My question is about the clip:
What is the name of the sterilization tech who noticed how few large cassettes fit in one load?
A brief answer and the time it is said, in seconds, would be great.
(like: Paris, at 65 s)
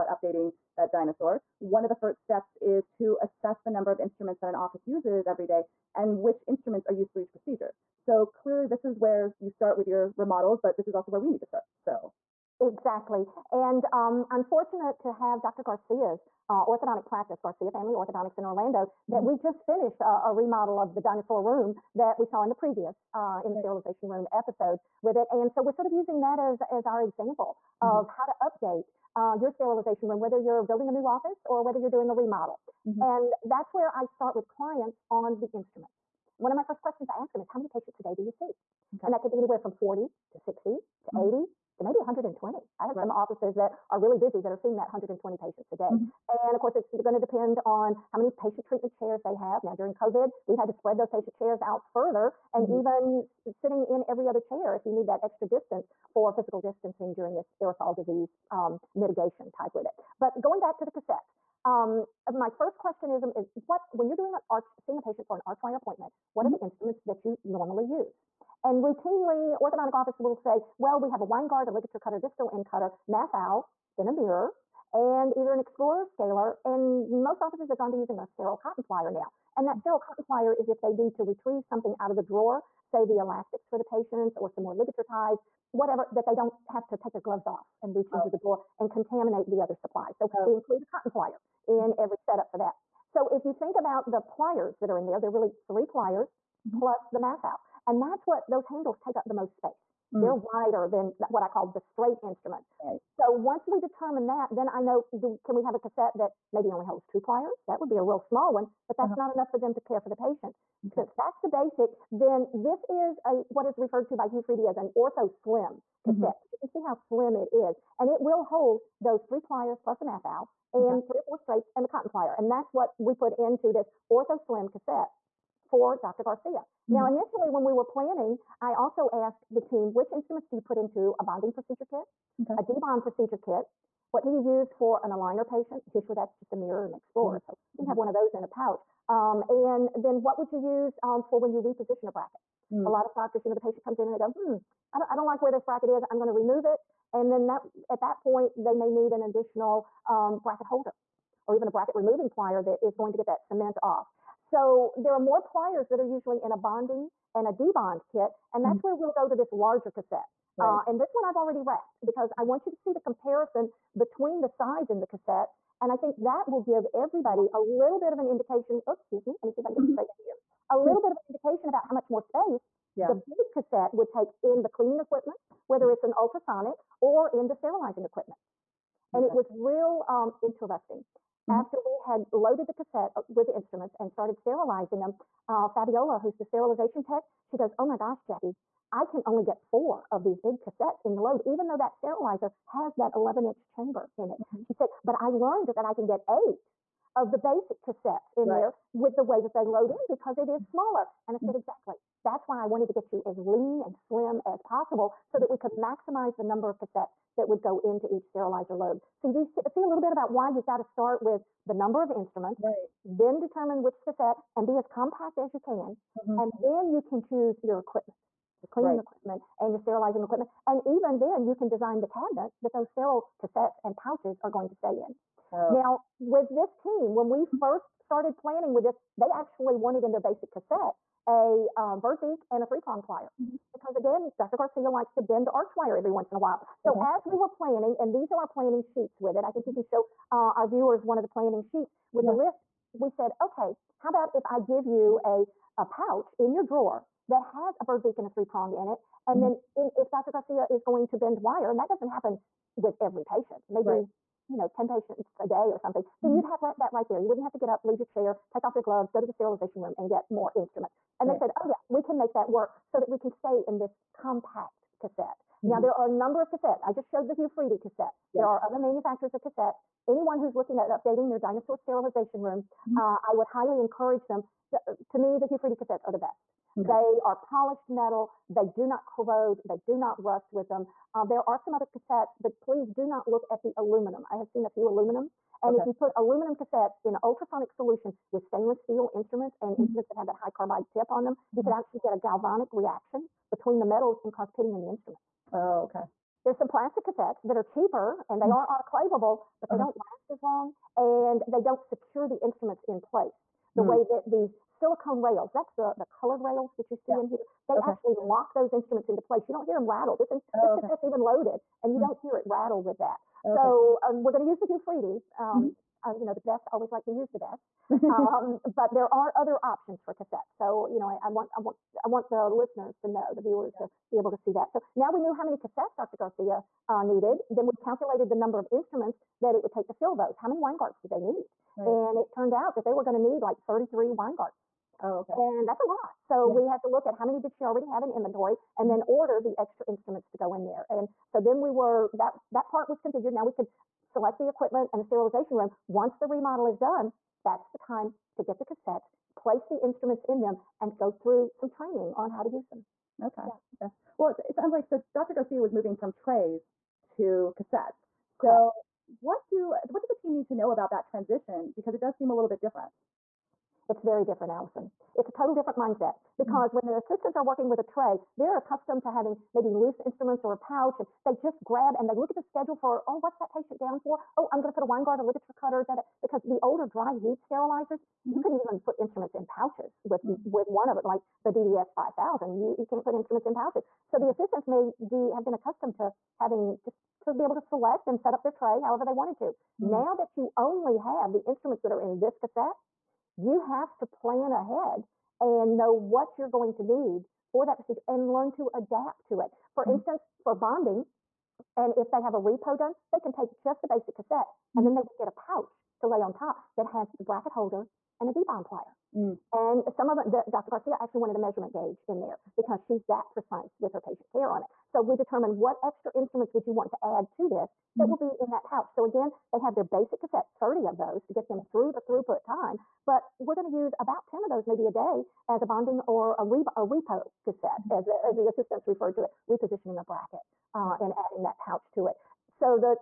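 Fabiola, at 185 s.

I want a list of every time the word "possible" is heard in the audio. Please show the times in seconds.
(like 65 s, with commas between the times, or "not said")
204 s.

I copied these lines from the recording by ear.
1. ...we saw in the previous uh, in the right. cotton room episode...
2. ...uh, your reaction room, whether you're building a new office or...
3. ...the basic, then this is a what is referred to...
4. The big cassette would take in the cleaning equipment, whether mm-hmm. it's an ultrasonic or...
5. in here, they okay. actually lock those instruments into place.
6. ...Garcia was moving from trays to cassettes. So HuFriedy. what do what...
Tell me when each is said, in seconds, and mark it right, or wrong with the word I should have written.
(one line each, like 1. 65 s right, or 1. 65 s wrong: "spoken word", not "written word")
1. 22 s wrong: "sterilization", not "cotton"
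2. 29 s wrong: "sterilization", not "reaction"
3. 111 s right
4. 173 s right
5. 307 s right
6. 355 s wrong: "Correct", not "HuFriedy".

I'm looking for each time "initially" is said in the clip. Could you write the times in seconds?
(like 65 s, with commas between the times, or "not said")
127 s.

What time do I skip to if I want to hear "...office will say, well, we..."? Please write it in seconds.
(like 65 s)
69 s.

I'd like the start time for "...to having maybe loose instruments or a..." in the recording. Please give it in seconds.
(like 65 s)
369 s.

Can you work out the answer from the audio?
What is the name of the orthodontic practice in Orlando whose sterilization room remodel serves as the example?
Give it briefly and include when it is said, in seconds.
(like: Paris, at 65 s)
Garcia Family Orthodontics, at 17 s.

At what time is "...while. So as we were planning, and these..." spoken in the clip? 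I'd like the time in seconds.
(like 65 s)
236 s.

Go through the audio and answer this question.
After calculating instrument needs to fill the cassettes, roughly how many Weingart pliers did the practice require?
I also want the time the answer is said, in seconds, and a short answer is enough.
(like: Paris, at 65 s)
33, at 333 s.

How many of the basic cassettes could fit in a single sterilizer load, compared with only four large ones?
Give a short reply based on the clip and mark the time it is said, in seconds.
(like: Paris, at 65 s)
8, at 196 s.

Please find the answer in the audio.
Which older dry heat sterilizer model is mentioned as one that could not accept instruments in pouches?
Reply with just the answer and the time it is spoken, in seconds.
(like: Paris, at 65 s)
DDS 5000, at 381 s.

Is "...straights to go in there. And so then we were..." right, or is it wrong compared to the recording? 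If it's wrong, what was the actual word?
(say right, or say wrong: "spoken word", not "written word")
wrong: "instruments", not "straights".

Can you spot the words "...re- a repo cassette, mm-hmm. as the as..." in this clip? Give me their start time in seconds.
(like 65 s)
426 s.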